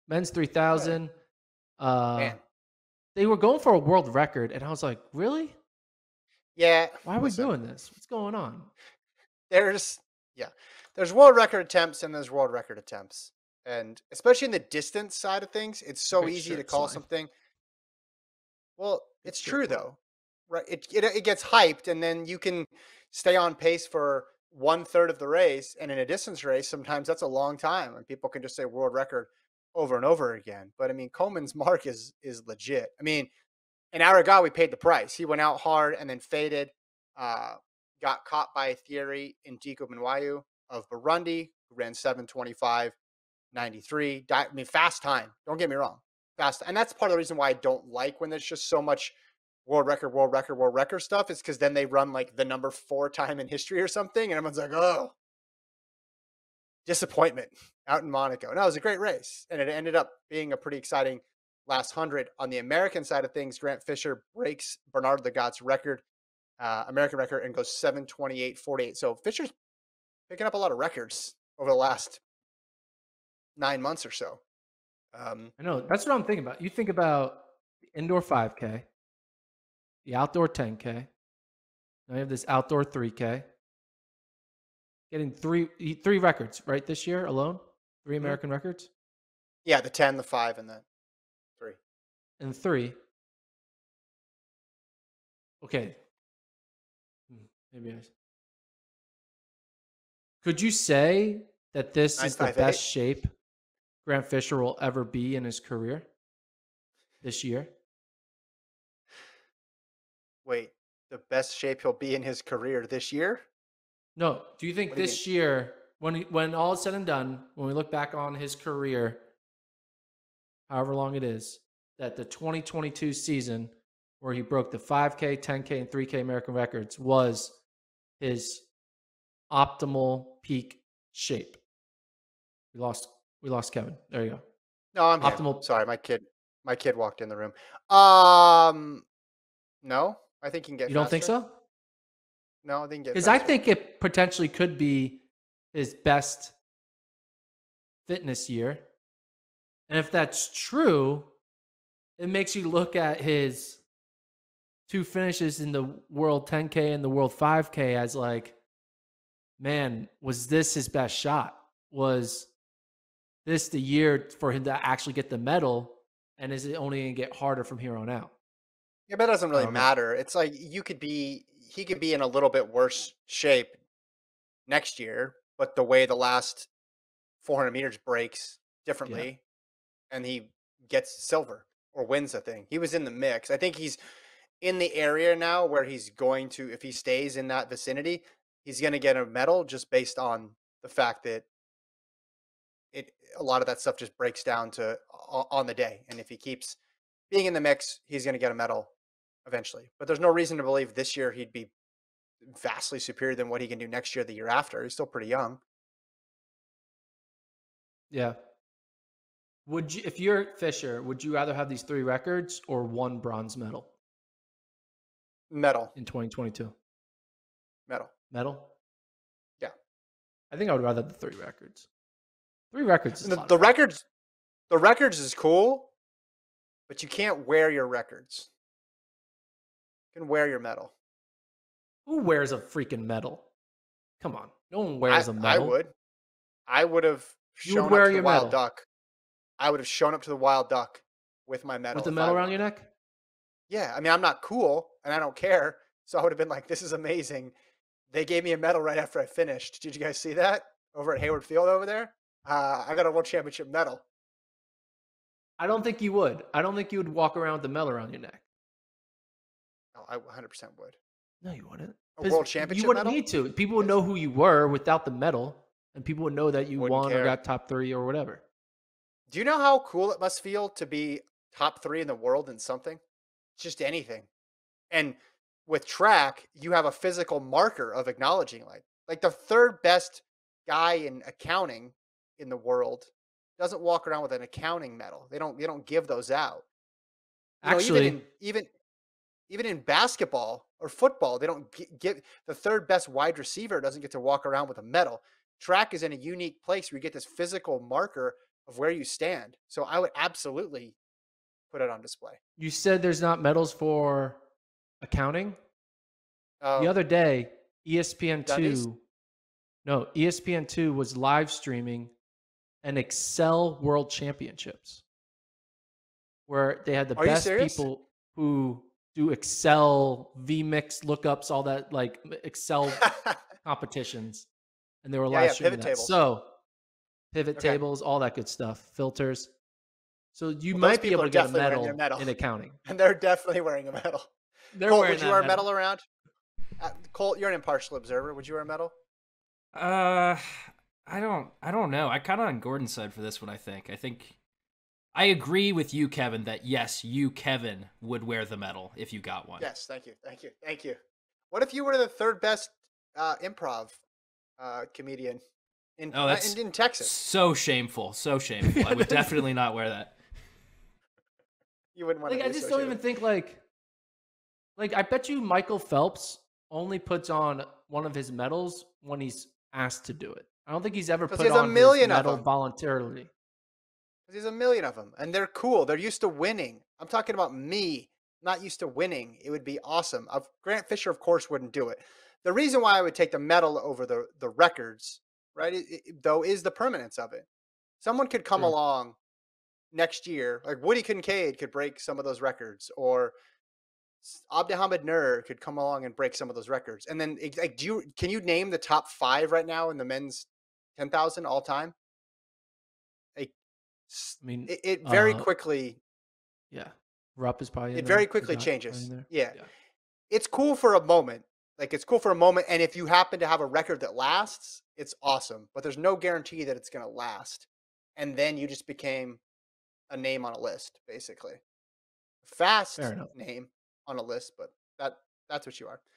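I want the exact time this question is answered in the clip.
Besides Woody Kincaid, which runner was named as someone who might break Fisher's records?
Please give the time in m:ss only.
6:34.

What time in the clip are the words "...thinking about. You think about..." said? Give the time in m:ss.
1:16.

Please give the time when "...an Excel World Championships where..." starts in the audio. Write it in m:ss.
5:12.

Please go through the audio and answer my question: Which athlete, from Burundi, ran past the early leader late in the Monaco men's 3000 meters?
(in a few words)
Diko Minwayu.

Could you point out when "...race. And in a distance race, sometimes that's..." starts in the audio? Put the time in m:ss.
0:25.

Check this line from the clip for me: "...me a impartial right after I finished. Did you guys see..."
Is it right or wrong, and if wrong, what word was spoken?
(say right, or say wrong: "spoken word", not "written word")
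wrong: "medal", not "impartial".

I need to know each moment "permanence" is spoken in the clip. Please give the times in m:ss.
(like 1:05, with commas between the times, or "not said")
6:26.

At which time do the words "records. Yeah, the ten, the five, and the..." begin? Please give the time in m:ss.
1:28.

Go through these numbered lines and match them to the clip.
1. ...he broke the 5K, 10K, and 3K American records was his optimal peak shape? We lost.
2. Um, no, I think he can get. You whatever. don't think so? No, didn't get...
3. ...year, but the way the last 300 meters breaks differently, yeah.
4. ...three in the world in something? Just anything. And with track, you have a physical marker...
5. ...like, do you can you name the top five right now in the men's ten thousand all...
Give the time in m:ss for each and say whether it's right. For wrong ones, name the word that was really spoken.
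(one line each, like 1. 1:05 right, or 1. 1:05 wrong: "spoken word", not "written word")
1. 2:04 right
2. 2:17 wrong: "faster", not "whatever"
3. 2:54 wrong: "400", not "300"
4. 4:31 right
5. 6:37 right.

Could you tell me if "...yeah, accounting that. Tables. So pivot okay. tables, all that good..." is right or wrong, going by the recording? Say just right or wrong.
wrong.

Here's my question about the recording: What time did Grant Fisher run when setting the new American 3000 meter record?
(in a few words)
7:28.48.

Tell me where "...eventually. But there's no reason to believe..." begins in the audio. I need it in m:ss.
3:19.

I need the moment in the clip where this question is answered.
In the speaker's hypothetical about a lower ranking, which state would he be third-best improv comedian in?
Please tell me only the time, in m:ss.
5:56.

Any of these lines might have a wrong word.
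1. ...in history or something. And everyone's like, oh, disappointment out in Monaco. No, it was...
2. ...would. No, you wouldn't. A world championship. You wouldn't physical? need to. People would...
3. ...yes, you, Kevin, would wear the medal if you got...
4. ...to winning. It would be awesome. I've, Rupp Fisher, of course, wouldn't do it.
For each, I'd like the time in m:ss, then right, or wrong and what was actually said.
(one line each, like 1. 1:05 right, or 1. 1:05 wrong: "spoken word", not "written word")
1. 0:53 right
2. 4:20 wrong: "medal", not "physical"
3. 5:46 right
4. 6:18 wrong: "Grant", not "Rupp".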